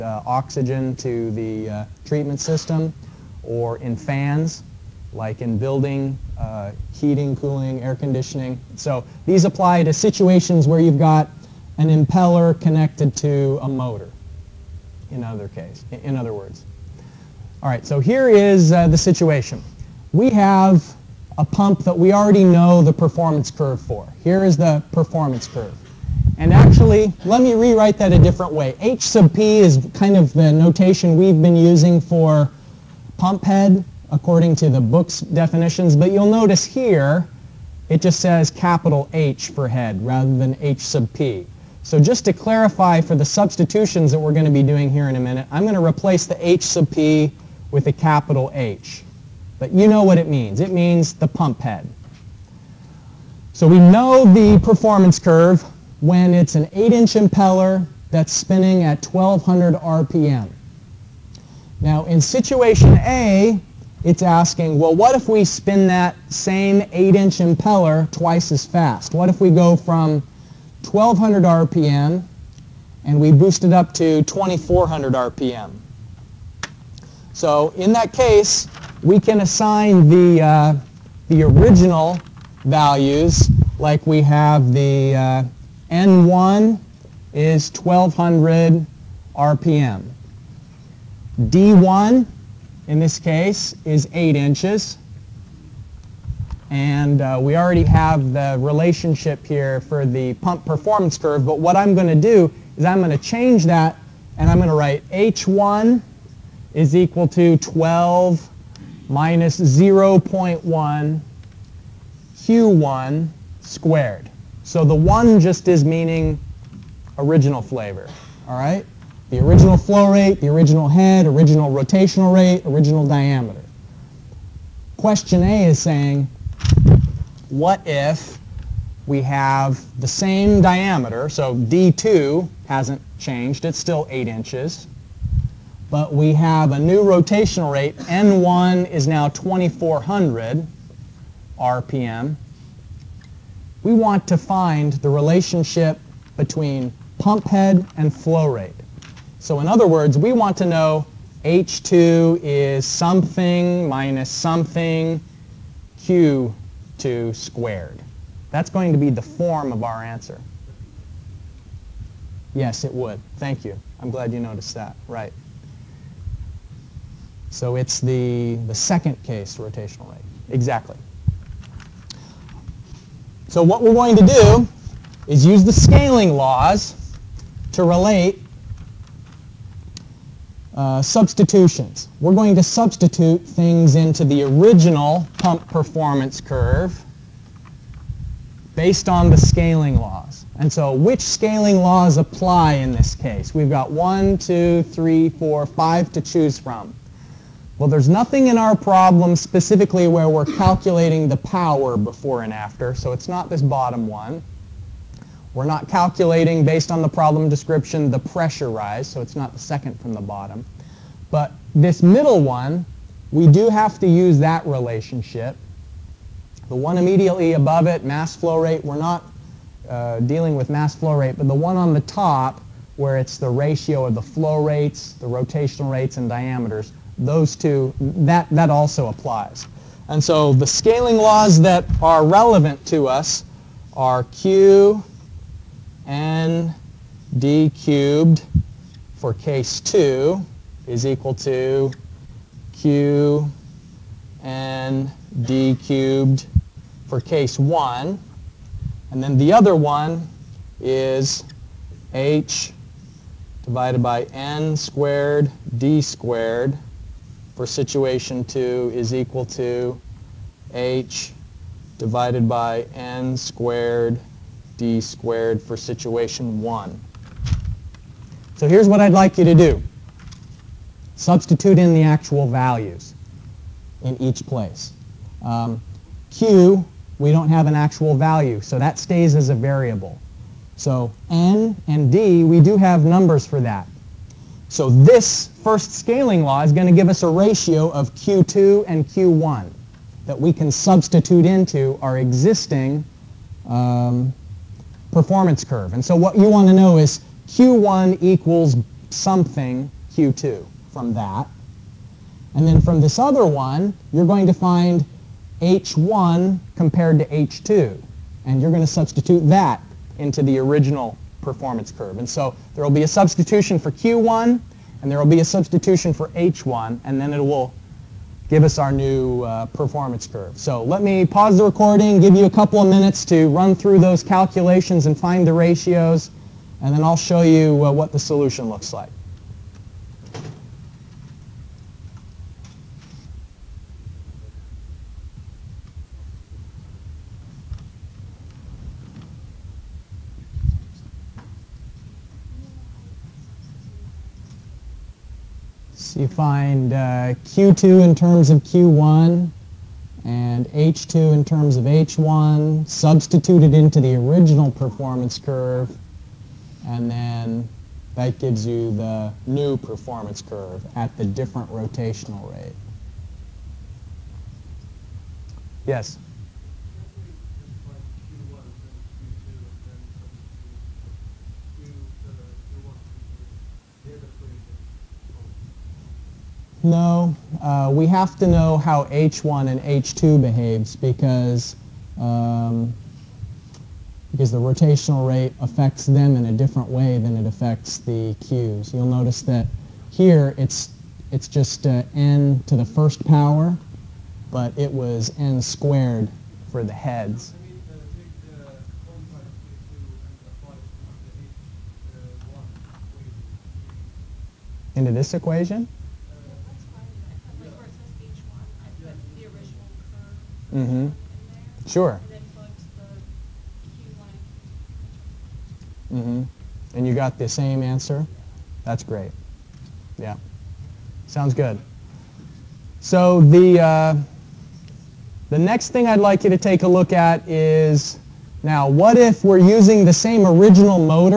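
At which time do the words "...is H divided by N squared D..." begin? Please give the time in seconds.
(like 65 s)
250 s.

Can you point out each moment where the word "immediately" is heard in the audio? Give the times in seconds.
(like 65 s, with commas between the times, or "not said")
216 s.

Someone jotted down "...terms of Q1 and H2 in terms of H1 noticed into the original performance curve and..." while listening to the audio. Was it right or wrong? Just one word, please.
wrong.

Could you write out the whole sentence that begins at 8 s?
So these apply to situations where you've got an impeller connected to a motor, in other case, in other words.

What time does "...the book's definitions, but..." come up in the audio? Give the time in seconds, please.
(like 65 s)
34 s.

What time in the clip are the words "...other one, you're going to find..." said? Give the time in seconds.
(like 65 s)
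303 s.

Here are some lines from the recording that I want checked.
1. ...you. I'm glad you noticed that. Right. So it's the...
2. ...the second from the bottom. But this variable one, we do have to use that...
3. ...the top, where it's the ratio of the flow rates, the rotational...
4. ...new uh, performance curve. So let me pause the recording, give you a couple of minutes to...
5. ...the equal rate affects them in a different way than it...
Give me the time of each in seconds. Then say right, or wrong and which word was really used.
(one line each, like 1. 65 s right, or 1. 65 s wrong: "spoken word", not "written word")
1. 163 s right
2. 209 s wrong: "middle", not "variable"
3. 221 s right
4. 318 s right
5. 384 s wrong: "rotational", not "equal".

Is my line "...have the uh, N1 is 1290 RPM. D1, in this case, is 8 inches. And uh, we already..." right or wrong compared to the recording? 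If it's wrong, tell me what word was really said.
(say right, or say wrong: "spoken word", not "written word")
wrong: "1200", not "1290".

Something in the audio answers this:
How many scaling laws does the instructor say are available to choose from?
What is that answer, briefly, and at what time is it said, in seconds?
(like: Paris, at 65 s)
5, at 195 s.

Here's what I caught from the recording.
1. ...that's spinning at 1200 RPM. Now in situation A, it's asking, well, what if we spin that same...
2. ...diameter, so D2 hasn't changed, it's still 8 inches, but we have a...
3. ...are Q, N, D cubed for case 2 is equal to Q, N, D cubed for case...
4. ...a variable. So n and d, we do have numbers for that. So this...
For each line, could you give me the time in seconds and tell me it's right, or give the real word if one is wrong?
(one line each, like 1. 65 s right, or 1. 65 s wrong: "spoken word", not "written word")
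1. 58 s right
2. 130 s right
3. 233 s right
4. 279 s right.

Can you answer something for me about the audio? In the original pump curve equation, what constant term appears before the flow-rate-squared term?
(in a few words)
12.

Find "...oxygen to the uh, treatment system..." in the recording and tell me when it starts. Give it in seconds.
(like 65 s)
0 s.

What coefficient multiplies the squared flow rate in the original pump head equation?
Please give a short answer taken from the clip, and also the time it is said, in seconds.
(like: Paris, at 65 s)
0.1, at 109 s.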